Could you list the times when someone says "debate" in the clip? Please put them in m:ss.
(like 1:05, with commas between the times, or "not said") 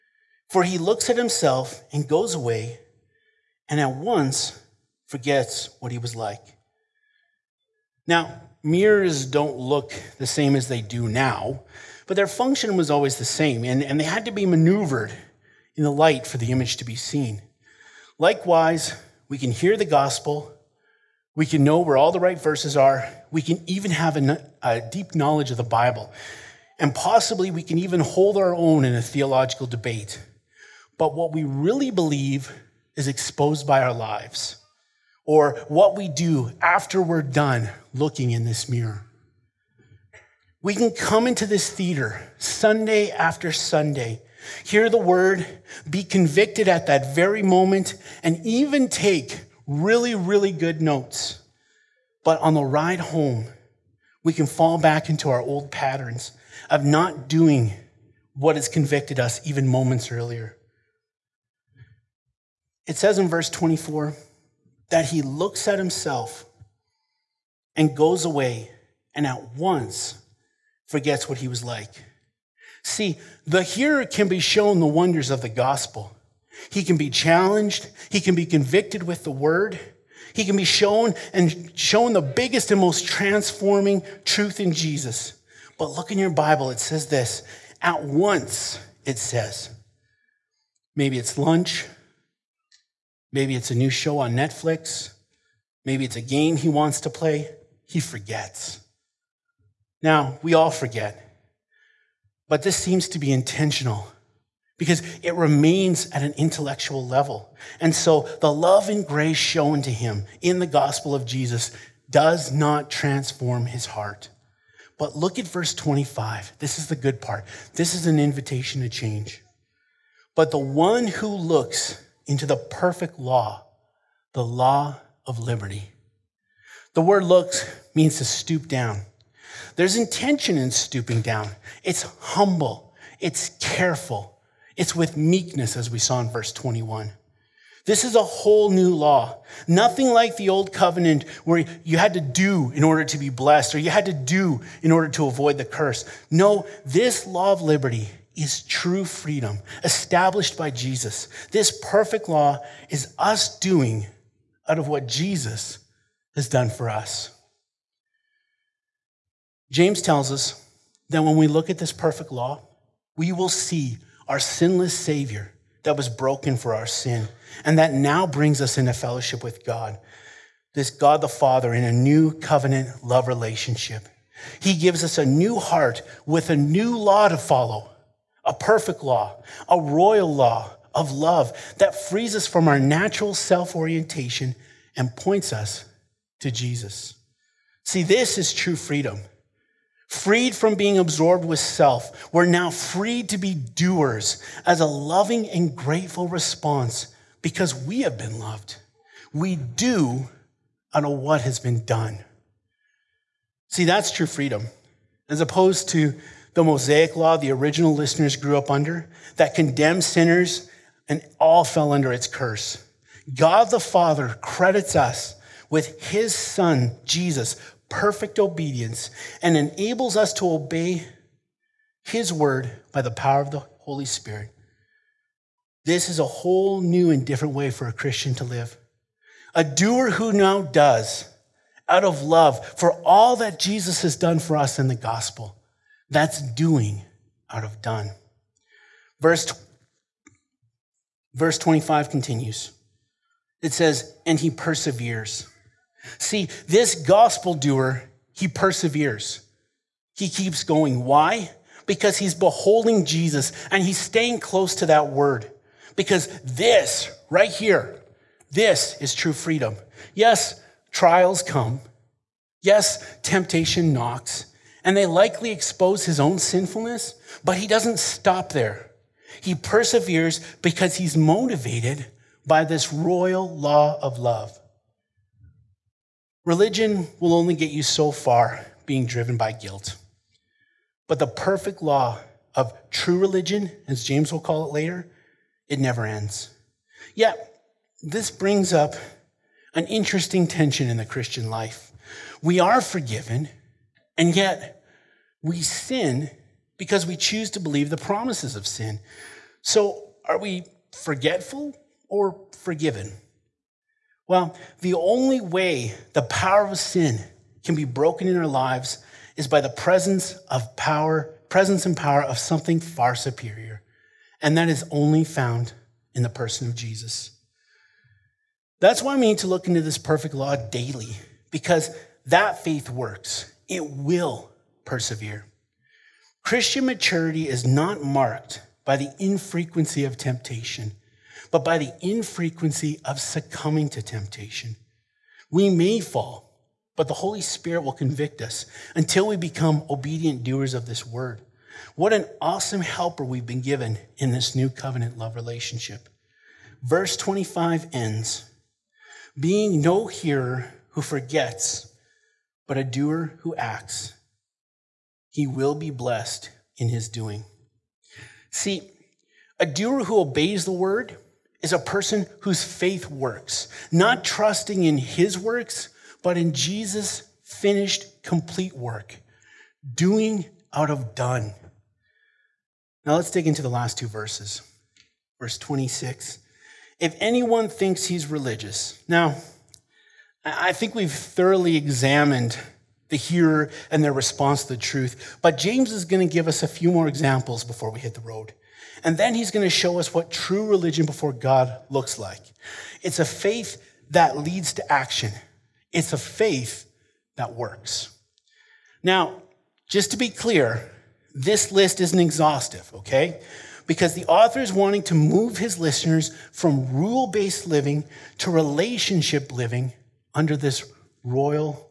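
0:29.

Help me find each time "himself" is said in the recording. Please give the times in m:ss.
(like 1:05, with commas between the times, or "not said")
0:01, 1:05.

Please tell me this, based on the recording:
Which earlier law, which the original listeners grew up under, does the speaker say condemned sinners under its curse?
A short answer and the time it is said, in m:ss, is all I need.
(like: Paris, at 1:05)
the Mosaic law, at 3:26.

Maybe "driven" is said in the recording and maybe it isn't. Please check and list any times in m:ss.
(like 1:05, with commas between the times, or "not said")
4:39.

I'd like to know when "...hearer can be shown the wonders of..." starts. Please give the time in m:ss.
1:13.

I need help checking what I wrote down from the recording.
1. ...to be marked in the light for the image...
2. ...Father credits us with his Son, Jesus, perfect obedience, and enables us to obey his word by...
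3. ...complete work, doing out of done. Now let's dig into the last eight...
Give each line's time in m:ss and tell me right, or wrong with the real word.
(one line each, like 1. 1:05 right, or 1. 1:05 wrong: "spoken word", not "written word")
1. 0:14 wrong: "maneuvered", not "marked"
2. 3:33 right
3. 6:08 wrong: "two", not "eight".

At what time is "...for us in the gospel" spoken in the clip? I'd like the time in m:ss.
3:54.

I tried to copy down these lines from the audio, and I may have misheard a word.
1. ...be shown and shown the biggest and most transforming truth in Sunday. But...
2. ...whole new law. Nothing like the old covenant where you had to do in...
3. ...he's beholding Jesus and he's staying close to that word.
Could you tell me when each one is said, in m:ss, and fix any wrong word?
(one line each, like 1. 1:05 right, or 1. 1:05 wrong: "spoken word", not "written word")
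1. 1:20 wrong: "Jesus", not "Sunday"
2. 2:18 right
3. 4:12 right.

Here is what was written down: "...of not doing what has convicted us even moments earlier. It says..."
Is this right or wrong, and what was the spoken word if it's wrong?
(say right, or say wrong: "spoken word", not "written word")
right.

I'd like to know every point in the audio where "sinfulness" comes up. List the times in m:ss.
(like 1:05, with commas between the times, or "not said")
4:26.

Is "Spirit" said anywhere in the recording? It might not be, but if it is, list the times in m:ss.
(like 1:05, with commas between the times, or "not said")
3:44, 5:37.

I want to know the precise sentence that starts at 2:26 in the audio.
No, this law of liberty is true freedom established by Jesus.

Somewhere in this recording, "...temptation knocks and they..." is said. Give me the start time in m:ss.
4:23.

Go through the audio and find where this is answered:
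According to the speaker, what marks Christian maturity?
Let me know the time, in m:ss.
5:32.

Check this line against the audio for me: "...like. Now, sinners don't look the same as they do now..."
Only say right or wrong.
wrong.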